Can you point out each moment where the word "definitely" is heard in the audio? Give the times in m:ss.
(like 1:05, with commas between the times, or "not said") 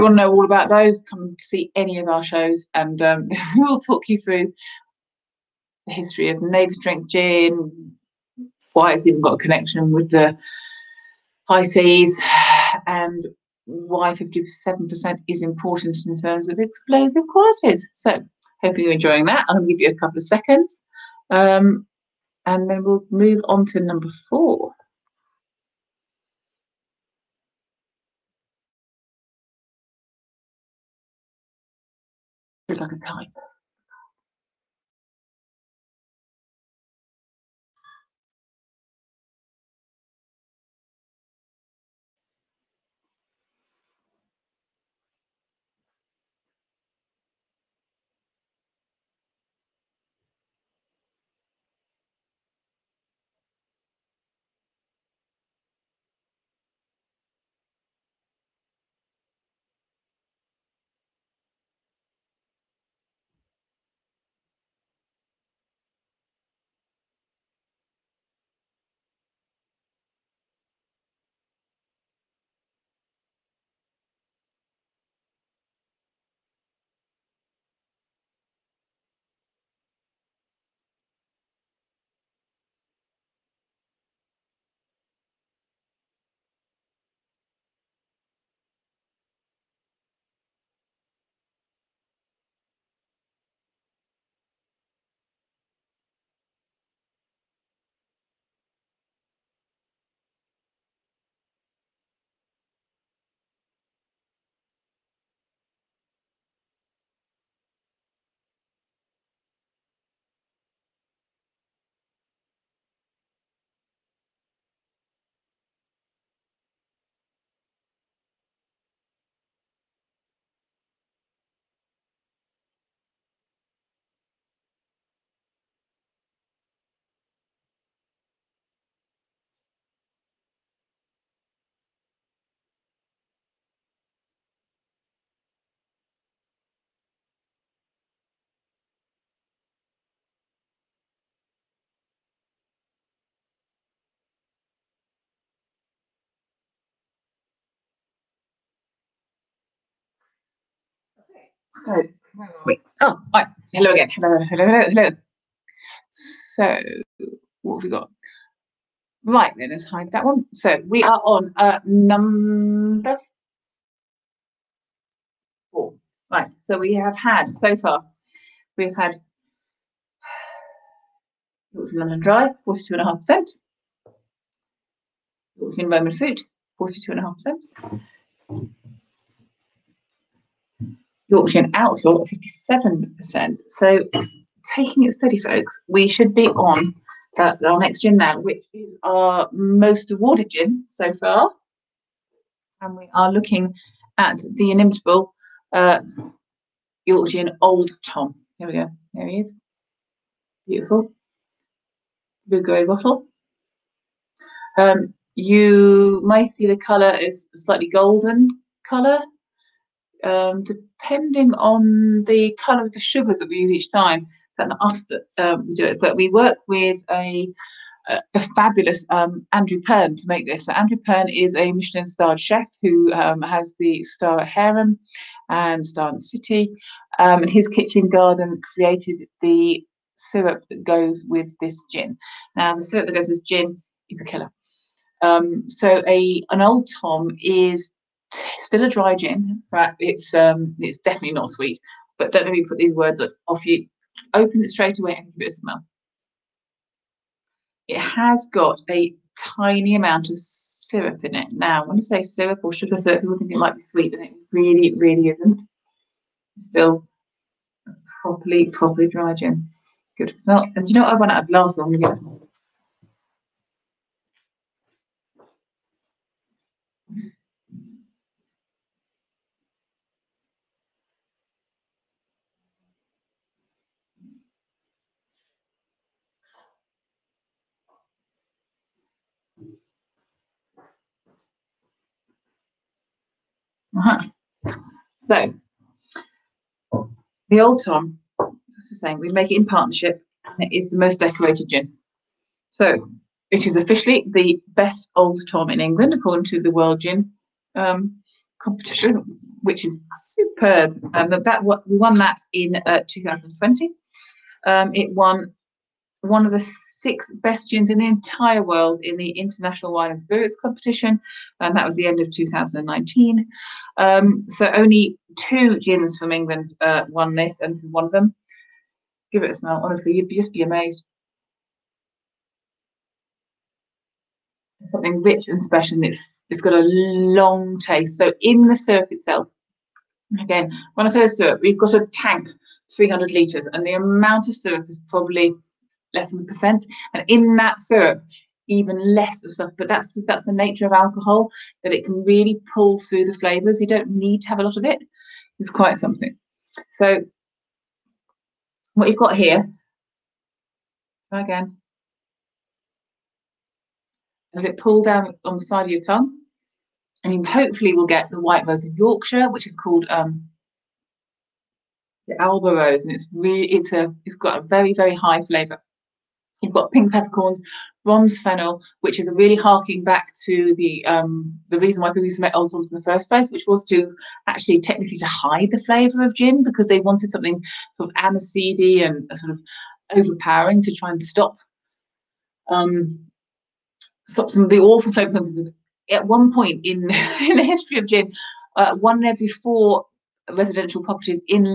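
4:00.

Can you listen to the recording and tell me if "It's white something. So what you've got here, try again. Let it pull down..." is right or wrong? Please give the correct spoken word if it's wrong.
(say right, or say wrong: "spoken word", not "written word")
wrong: "quite", not "white".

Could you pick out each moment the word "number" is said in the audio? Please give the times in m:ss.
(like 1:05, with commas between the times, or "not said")
0:23, 2:41.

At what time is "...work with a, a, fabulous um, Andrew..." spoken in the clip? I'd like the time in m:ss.
3:36.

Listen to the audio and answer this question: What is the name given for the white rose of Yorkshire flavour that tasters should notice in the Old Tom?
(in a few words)
Alba Rose.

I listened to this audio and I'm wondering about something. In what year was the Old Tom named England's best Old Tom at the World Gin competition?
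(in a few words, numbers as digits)
2020.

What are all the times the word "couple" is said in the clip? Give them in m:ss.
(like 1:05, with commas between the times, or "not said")
0:19.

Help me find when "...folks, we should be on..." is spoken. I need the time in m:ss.
3:05.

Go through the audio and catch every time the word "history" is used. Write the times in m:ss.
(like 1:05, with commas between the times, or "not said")
0:05, 6:27.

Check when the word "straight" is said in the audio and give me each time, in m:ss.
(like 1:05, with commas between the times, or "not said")
4:04.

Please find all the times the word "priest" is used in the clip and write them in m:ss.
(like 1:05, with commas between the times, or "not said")
not said.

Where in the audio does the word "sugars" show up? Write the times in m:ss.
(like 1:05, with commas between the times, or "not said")
3:32, 4:12.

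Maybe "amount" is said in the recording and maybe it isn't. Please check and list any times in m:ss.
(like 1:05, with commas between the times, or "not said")
4:09, 5:33.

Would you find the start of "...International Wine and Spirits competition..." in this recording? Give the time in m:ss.
5:09.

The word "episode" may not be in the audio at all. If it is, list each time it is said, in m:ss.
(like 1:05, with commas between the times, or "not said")
not said.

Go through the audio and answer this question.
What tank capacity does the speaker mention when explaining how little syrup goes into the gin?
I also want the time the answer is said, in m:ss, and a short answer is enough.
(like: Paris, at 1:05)
300 litres, at 5:32.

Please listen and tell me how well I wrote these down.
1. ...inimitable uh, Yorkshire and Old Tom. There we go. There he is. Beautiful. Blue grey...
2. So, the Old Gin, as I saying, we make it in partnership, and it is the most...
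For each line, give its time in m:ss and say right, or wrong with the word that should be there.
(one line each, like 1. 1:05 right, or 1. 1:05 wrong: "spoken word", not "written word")
1. 3:14 right
2. 4:45 wrong: "Tom", not "Gin".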